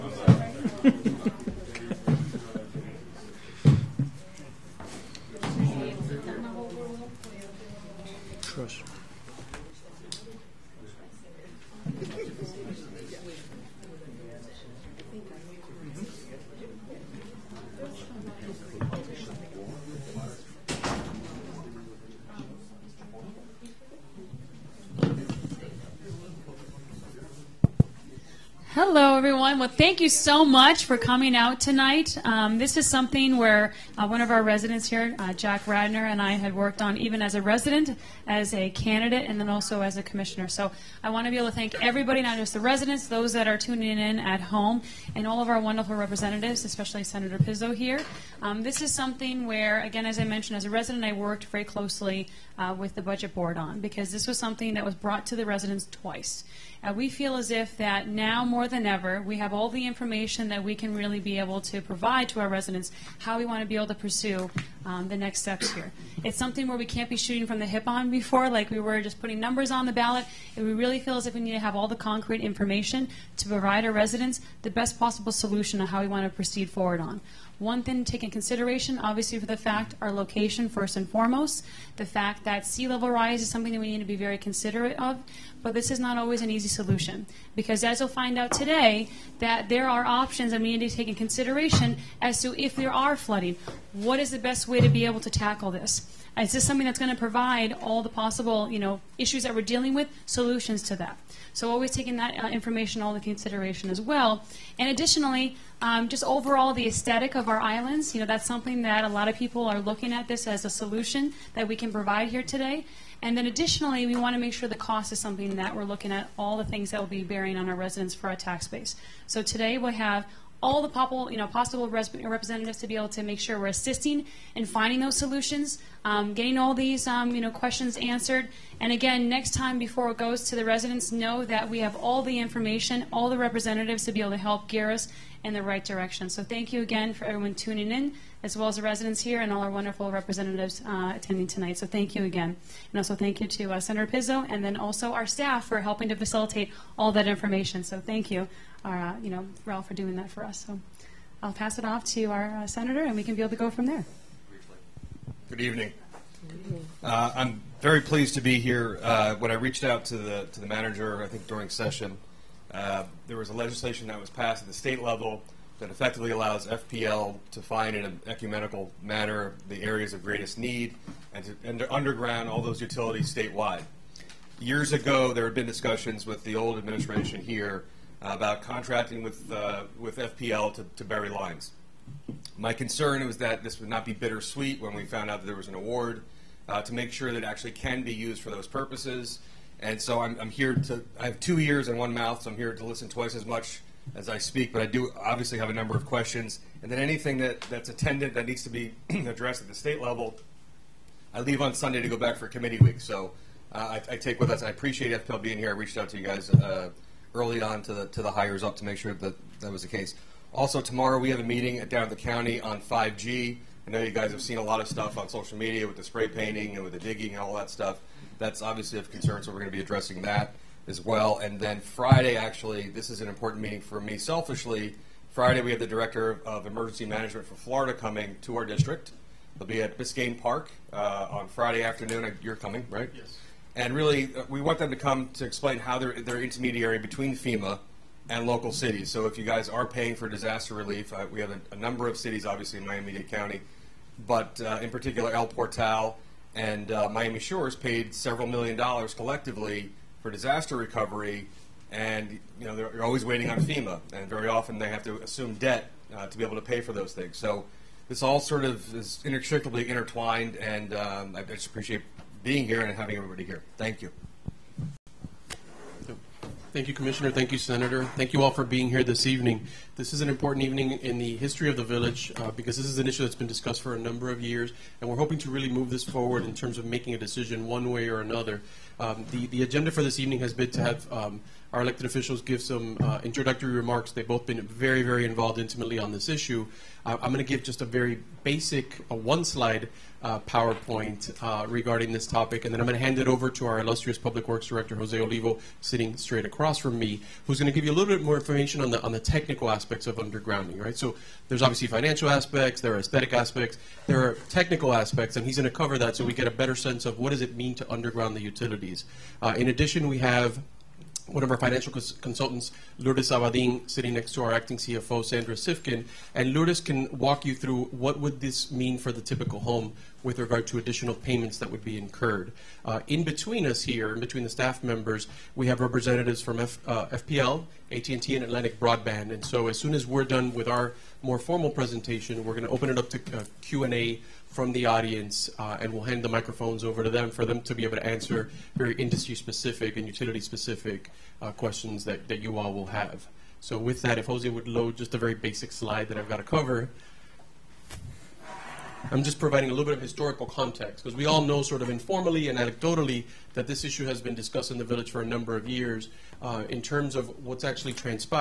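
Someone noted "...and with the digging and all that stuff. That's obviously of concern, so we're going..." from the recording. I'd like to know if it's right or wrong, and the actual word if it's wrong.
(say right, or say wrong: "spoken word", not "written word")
right.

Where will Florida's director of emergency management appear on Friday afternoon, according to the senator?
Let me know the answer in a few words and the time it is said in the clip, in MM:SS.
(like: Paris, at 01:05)
Biscayne Park, at 03:49.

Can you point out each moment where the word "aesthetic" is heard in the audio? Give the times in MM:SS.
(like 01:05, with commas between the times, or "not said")
01:46, 05:02.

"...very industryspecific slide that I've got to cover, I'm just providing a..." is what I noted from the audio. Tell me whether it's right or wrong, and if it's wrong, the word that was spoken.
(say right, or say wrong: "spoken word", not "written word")
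wrong: "basic", not "industryspecific".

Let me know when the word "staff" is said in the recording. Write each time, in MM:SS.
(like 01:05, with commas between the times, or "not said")
02:25, 05:24.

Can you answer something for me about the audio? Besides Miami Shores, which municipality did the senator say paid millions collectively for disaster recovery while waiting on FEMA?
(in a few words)
El Portal.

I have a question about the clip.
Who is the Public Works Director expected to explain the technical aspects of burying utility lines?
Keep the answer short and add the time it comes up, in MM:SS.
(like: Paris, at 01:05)
Jose Olivo, at 04:54.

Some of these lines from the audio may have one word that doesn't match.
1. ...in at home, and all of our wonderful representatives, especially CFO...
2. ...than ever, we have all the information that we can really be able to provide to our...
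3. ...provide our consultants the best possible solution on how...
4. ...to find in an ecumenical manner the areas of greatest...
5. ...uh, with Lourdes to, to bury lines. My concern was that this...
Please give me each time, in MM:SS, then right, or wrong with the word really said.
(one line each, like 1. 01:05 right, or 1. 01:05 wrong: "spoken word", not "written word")
1. 00:43 wrong: "Senator", not "CFO"
2. 00:58 right
3. 01:13 wrong: "residents", not "consultants"
4. 02:47 right
5. 02:59 wrong: "FPL", not "Lourdes".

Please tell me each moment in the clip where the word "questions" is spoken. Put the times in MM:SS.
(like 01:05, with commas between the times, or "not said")
02:07, 03:16, 05:41.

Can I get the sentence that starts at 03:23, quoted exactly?
So uh, I, I, take with us, I appreciate FPL being here.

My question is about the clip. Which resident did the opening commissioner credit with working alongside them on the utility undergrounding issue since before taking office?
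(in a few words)
Jack Radner.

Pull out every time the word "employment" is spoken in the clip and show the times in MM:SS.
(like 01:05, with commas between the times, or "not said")
not said.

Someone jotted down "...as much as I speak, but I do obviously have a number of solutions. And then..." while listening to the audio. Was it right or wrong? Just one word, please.
wrong.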